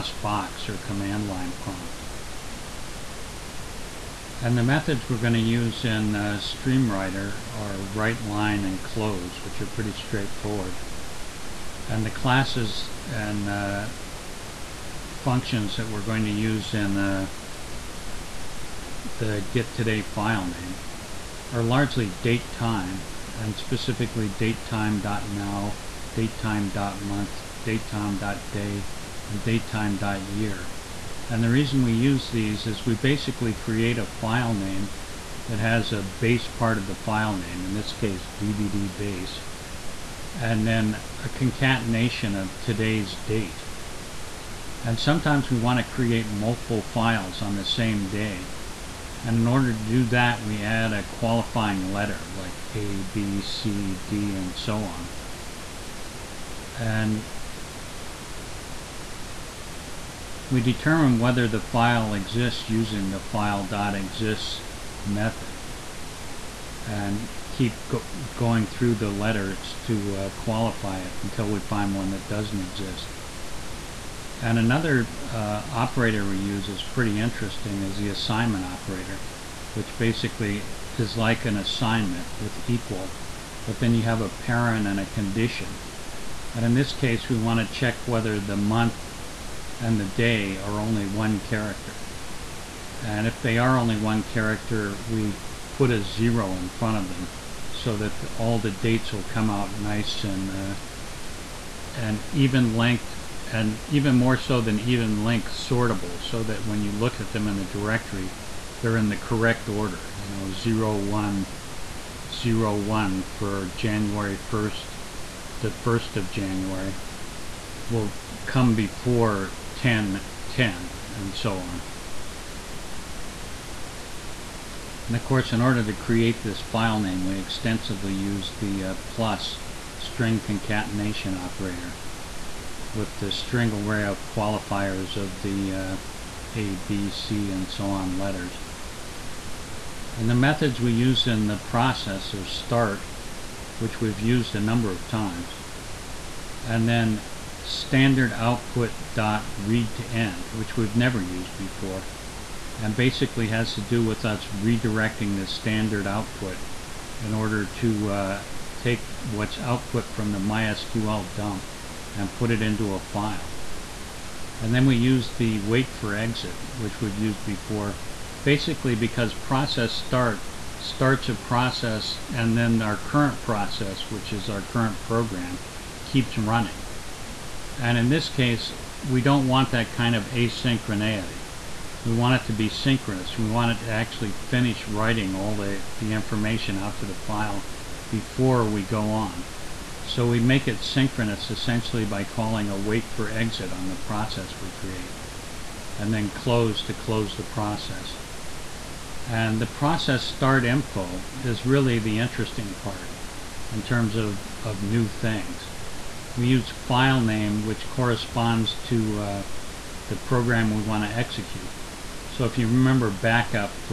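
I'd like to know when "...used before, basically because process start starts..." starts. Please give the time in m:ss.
2:47.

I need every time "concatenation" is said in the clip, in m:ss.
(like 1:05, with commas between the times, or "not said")
0:41, 2:10.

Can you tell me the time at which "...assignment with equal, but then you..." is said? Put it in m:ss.
1:21.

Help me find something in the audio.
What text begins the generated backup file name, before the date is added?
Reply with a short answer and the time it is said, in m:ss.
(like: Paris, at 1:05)
DVD base, at 0:38.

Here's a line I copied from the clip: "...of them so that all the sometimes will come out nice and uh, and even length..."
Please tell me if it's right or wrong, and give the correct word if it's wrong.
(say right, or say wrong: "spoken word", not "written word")
wrong: "dates", not "sometimes".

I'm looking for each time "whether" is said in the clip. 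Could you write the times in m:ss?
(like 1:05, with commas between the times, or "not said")
1:01, 1:28.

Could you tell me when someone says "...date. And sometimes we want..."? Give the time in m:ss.
0:43.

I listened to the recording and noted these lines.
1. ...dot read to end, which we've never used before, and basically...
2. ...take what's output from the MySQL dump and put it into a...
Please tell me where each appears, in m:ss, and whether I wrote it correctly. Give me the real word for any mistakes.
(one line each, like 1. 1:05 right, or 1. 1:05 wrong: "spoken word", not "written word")
1. 2:29 right
2. 2:38 right.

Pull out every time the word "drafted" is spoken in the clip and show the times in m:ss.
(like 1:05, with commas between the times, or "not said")
not said.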